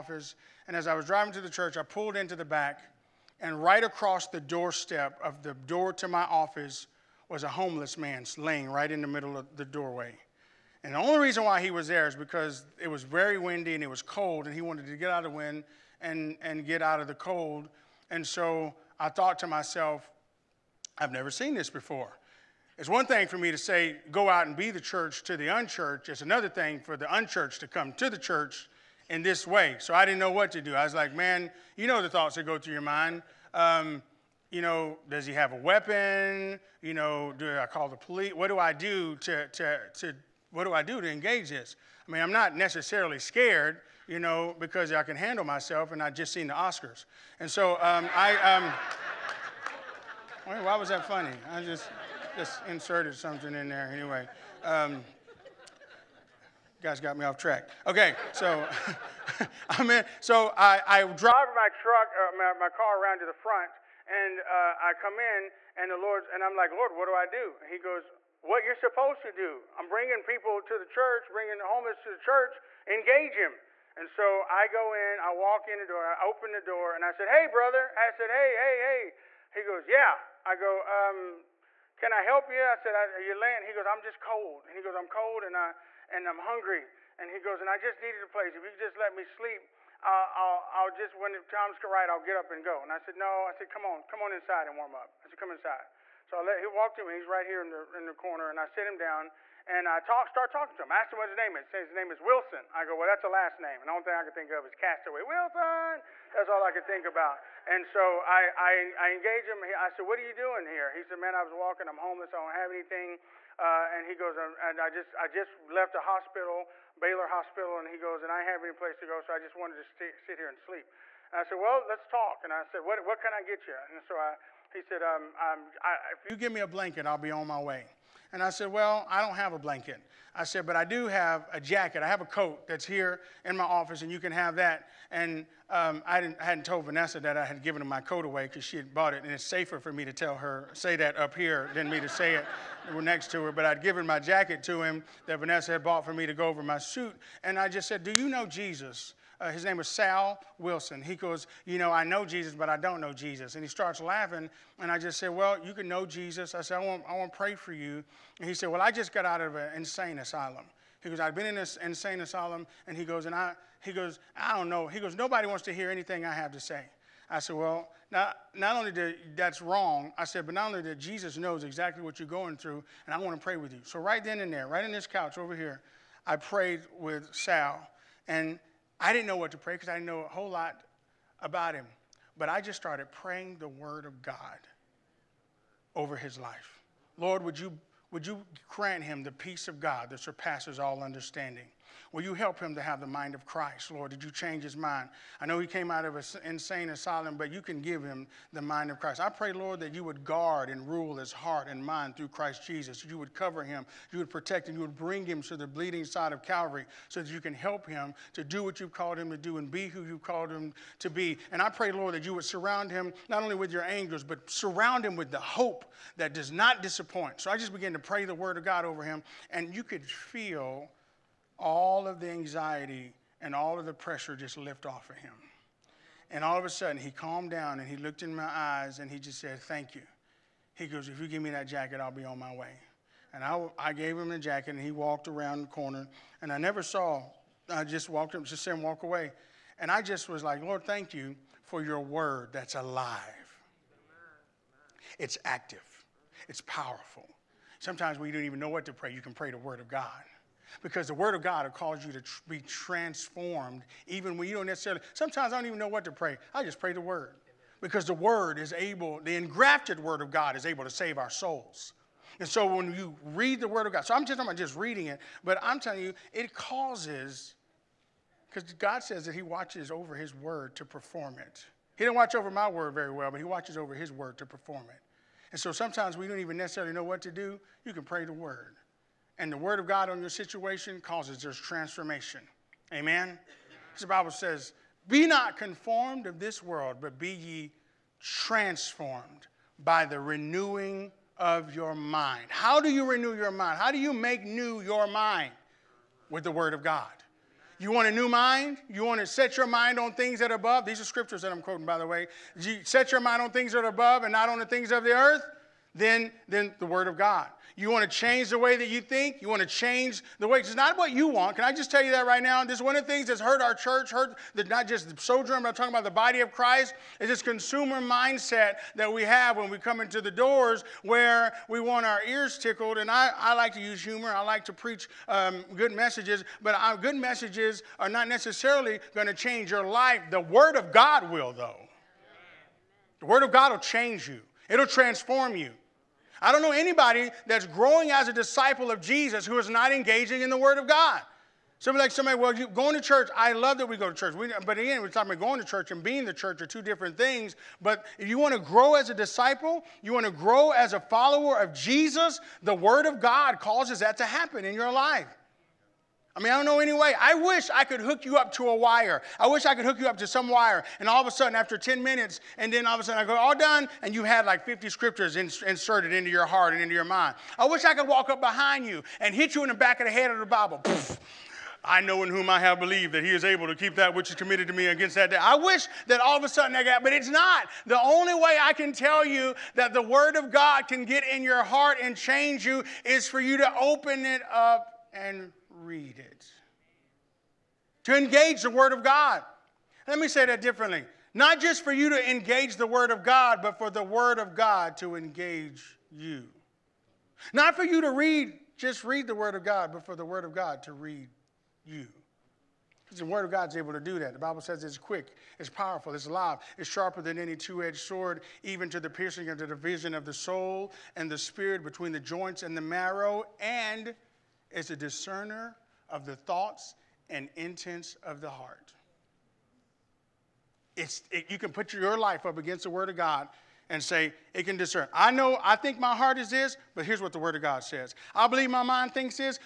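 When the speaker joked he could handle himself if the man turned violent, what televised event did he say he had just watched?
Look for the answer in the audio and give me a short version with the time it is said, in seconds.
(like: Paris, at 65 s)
The Oscars, at 46 s.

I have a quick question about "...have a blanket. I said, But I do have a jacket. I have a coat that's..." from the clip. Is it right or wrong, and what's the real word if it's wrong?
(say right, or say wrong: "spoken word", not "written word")
right.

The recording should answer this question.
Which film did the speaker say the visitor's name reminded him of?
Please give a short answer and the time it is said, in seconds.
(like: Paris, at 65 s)
Castaway, at 104 s.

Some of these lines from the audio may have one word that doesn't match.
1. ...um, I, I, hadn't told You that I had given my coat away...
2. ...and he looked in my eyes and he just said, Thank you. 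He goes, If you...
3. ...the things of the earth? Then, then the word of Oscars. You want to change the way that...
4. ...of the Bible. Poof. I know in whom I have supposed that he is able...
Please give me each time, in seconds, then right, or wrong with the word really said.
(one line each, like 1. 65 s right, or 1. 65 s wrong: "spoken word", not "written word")
1. 135 s wrong: "Vanessa", not "You"
2. 227 s right
3. 304 s wrong: "God", not "Oscars"
4. 370 s wrong: "believed", not "supposed".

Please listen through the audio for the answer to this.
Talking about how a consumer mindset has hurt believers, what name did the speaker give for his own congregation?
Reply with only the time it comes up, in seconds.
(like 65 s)
315 s.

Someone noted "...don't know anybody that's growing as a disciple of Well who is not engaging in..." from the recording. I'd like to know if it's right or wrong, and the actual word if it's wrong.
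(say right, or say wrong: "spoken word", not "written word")
wrong: "Jesus", not "Well".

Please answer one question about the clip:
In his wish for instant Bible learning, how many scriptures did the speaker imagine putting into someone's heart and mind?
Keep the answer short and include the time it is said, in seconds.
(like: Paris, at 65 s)
50, at 364 s.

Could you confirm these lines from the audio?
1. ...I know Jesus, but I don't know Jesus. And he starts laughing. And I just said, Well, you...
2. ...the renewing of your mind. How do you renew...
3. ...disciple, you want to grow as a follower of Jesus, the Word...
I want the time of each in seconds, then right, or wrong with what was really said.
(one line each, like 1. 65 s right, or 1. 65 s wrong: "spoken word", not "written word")
1. 151 s right
2. 290 s right
3. 349 s right.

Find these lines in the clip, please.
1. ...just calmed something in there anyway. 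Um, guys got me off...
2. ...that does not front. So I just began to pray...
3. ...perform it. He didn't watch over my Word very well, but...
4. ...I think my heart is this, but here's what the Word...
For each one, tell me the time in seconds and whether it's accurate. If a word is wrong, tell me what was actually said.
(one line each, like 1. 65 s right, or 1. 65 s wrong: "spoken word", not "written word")
1. 52 s wrong: "inserted", not "calmed"
2. 216 s wrong: "disappoint", not "front"
3. 270 s right
4. 425 s right.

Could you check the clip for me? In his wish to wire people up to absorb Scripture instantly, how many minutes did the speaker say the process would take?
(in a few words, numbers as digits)
10 minutes.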